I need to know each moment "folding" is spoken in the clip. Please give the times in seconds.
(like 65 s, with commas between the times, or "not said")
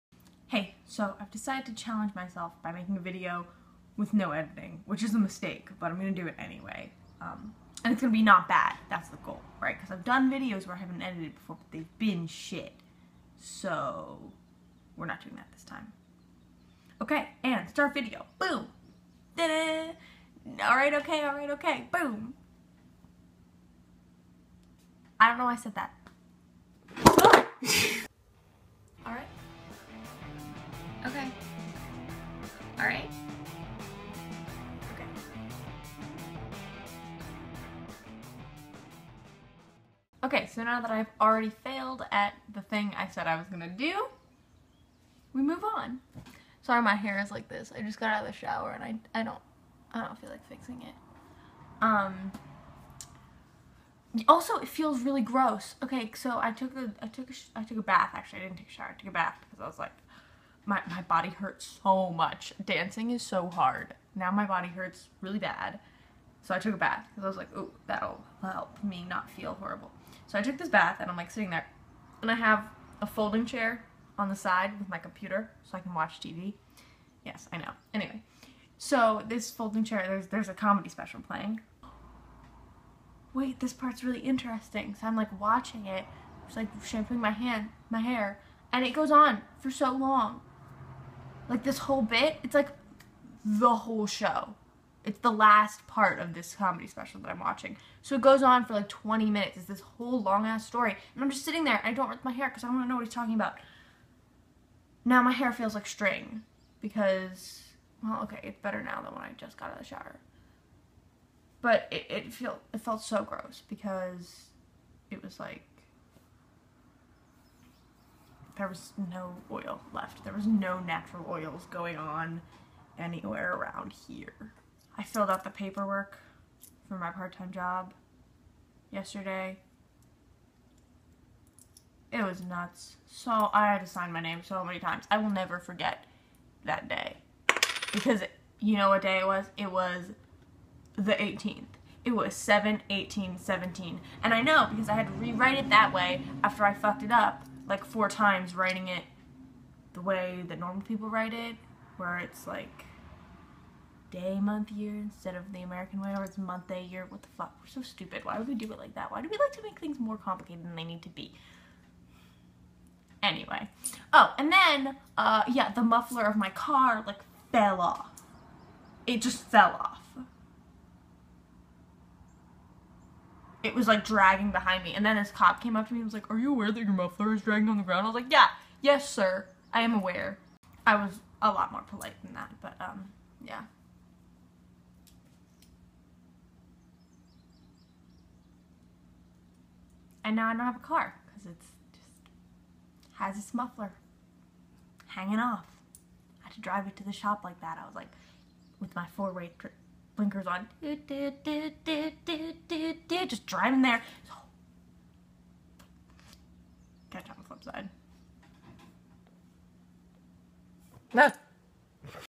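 73 s, 79 s.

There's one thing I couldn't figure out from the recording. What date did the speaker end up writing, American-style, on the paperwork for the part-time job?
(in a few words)
7/18/17.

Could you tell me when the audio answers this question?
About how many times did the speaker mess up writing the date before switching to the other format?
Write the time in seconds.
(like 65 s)
147 s.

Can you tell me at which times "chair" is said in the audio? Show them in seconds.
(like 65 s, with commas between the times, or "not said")
73 s, 79 s.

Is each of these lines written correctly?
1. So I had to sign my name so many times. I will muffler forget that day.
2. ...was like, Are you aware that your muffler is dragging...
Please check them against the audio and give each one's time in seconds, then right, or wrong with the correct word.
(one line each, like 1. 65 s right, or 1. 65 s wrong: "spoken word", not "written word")
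1. 133 s wrong: "never", not "muffler"
2. 176 s right.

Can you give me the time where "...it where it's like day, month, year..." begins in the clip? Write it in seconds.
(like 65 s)
151 s.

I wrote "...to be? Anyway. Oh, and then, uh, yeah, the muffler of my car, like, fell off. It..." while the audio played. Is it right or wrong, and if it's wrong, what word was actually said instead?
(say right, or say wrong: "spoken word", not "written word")
right.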